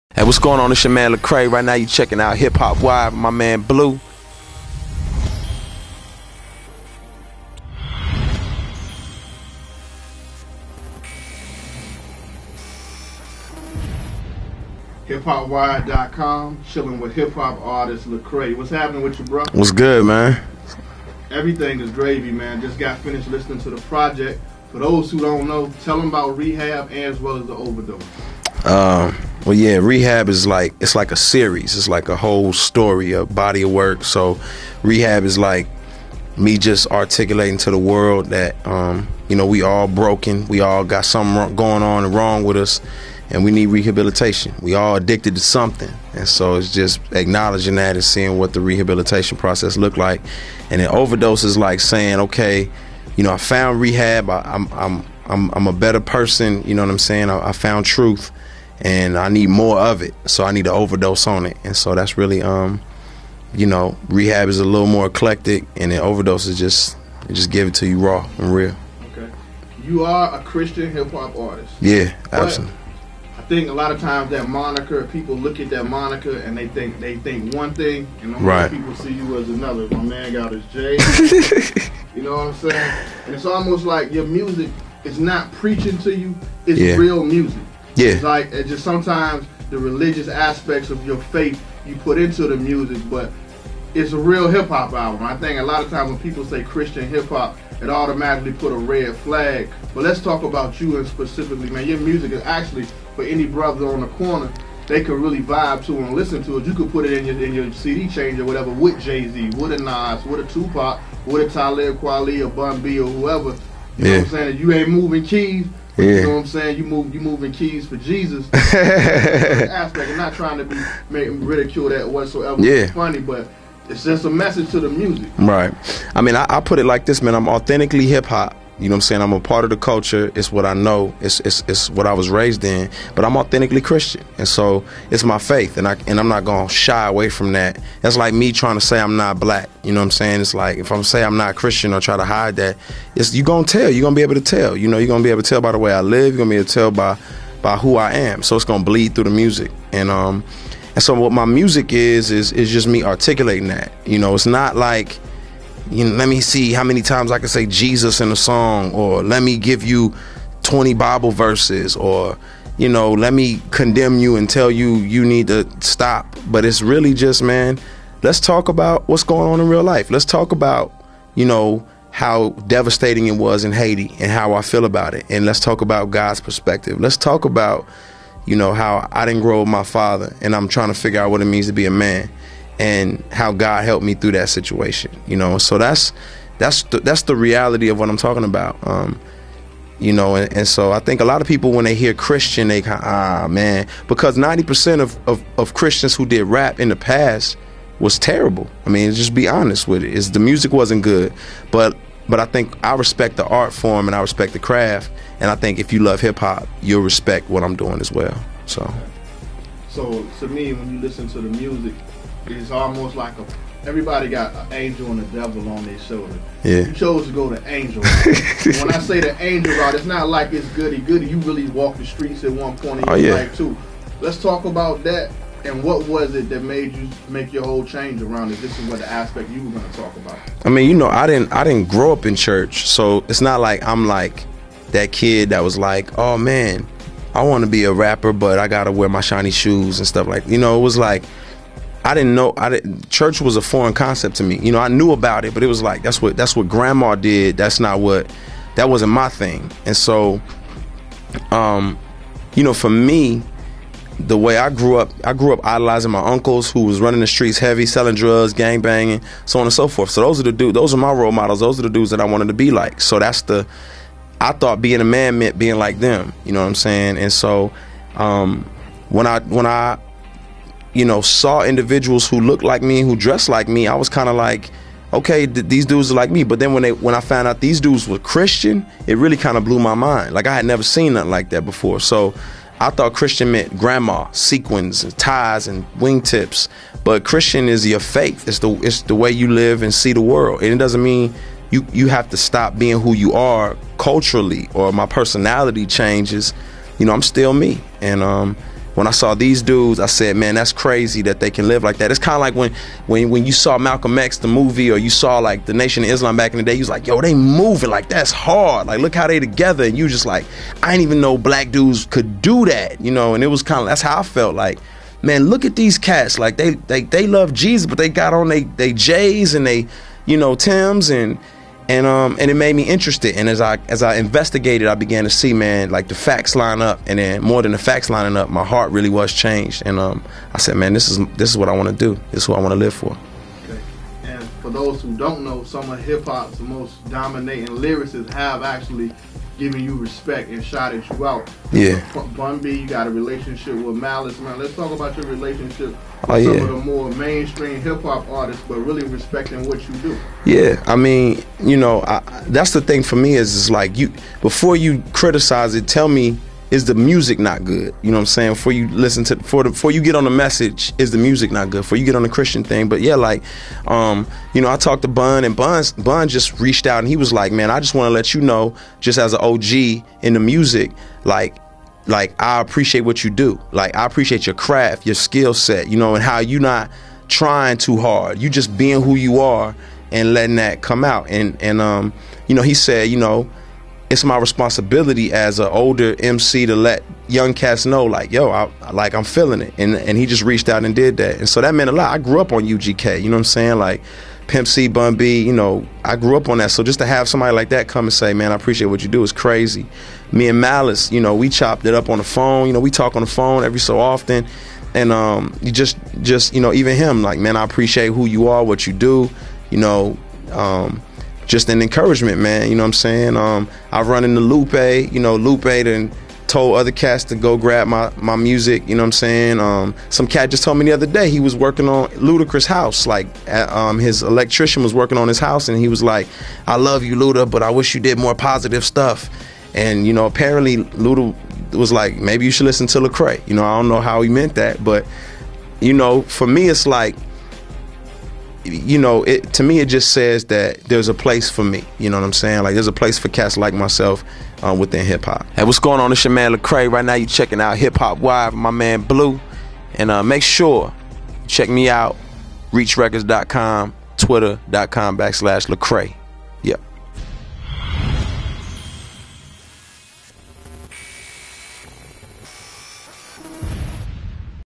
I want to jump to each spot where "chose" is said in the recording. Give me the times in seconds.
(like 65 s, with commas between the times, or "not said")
216 s.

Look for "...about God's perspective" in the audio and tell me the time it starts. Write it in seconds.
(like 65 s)
175 s.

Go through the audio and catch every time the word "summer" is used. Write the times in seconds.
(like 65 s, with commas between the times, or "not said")
not said.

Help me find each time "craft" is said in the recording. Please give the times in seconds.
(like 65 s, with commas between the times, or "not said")
204 s, 374 s.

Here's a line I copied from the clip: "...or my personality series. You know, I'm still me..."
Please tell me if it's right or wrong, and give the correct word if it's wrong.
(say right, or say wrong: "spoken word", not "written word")
wrong: "changes", not "series".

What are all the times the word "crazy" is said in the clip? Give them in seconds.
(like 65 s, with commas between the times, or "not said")
300 s, 399 s.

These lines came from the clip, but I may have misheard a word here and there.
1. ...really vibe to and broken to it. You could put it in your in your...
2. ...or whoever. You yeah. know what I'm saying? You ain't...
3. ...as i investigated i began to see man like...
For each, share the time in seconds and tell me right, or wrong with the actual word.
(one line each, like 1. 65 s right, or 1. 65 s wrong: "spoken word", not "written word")
1. 105 s wrong: "listen", not "broken"
2. 112 s right
3. 323 s right.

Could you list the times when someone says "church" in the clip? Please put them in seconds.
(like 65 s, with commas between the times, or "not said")
232 s, 243 s.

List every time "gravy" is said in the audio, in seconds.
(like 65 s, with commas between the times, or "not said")
21 s.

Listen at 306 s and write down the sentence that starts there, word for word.
You was like, yo, they moving like that's hard.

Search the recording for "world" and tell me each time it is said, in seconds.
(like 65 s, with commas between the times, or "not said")
37 s, 290 s.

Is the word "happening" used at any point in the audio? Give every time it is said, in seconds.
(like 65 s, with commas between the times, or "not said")
18 s.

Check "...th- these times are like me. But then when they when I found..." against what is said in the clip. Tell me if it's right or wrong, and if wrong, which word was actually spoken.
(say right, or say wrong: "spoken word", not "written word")
wrong: "dudes", not "times".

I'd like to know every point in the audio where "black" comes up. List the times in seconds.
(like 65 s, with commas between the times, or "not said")
139 s, 311 s.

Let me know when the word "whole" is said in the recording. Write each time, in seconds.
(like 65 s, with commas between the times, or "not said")
32 s, 227 s.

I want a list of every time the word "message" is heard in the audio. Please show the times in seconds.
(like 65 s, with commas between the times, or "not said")
124 s, 360 s.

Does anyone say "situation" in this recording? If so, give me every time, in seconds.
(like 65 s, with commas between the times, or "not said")
184 s.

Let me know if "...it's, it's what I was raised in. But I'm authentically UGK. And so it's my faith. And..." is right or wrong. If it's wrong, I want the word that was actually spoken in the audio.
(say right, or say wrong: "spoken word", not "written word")
wrong: "Christian", not "UGK".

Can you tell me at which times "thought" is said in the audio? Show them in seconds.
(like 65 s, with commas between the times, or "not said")
264 s, 282 s.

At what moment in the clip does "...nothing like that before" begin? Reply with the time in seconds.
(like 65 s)
281 s.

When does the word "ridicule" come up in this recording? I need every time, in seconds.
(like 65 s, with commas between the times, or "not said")
121 s.